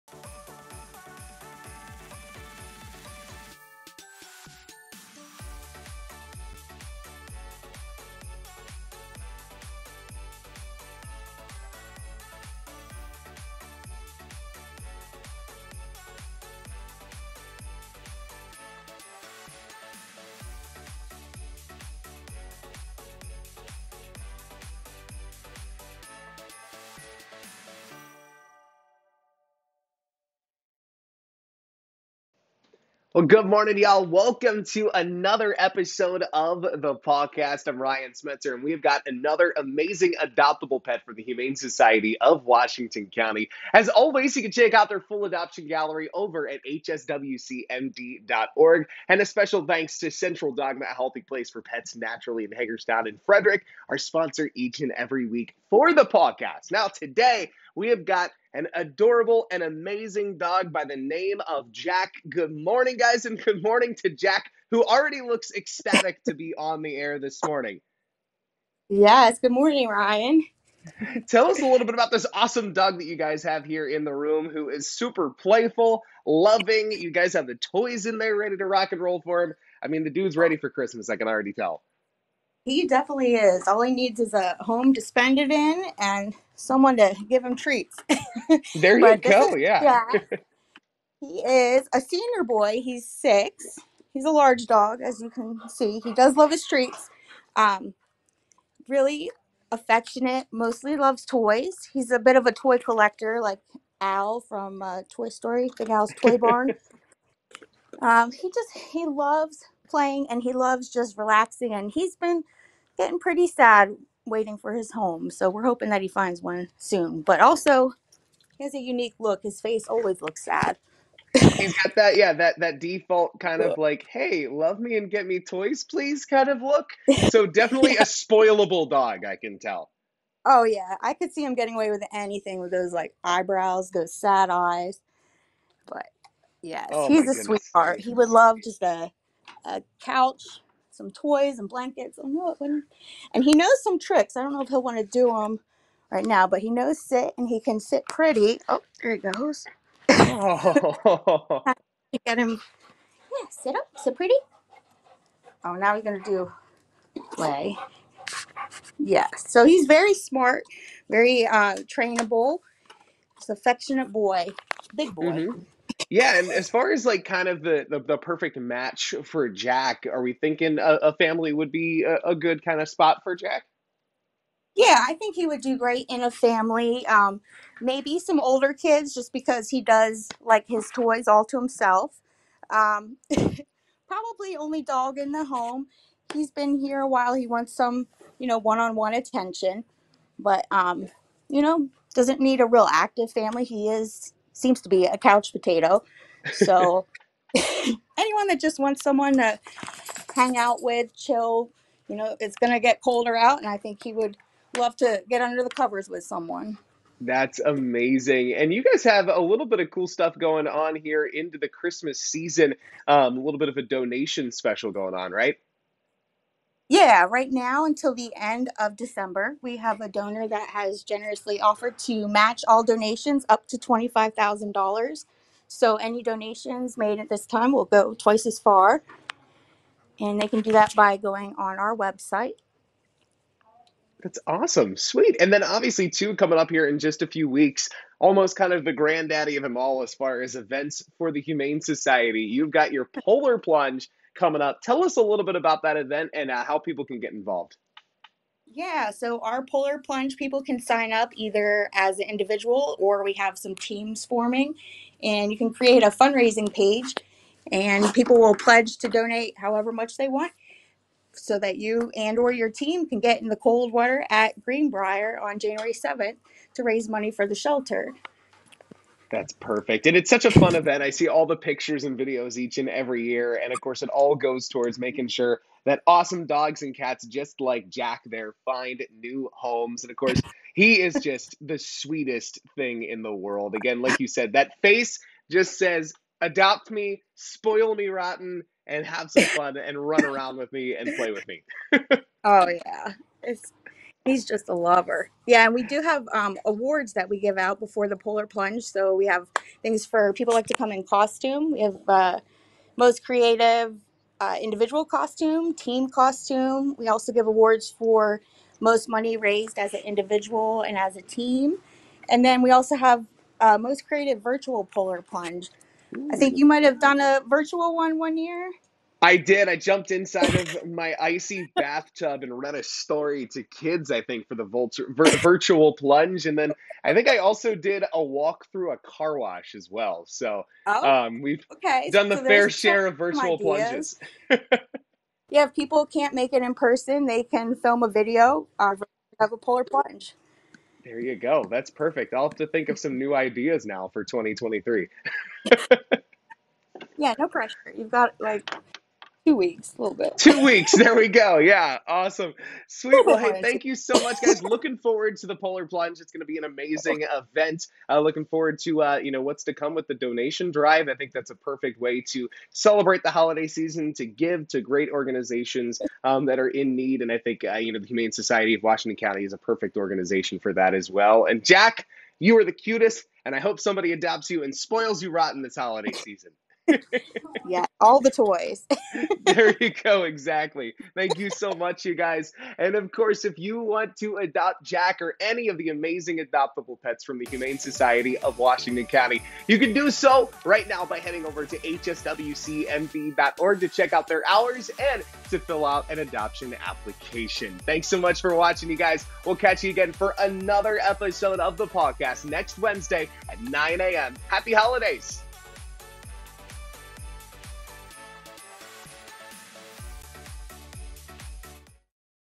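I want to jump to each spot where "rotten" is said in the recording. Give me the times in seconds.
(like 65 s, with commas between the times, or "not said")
288 s, 375 s.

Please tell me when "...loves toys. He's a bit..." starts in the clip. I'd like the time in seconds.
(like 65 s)
100 s.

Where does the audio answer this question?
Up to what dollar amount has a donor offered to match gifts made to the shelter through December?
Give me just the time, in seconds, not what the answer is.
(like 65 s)
223 s.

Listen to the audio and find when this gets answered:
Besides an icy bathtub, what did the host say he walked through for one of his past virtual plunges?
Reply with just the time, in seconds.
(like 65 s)
328 s.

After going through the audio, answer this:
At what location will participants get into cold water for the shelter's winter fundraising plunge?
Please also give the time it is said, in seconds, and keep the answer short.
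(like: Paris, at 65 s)
Greenbrier, at 264 s.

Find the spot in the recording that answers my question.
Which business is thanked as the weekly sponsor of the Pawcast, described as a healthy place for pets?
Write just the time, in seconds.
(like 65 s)
50 s.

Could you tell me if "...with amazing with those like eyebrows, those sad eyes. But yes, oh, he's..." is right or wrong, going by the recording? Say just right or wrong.
wrong.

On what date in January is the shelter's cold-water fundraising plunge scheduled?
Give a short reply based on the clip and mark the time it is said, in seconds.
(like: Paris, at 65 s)
January 7, at 265 s.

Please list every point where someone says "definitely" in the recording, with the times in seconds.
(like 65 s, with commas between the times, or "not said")
82 s, 127 s.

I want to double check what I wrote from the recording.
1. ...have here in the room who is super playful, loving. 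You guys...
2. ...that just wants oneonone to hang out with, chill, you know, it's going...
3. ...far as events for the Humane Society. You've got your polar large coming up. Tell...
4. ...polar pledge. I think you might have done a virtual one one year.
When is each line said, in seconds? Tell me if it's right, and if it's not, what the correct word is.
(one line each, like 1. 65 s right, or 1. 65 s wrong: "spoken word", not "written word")
1. 73 s right
2. 198 s wrong: "someone", not "oneonone"
3. 240 s wrong: "plunge", not "large"
4. 314 s wrong: "plunge", not "pledge".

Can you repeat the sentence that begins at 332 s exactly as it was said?
done the so fair share of virtual plunges.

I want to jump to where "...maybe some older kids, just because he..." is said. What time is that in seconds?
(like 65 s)
177 s.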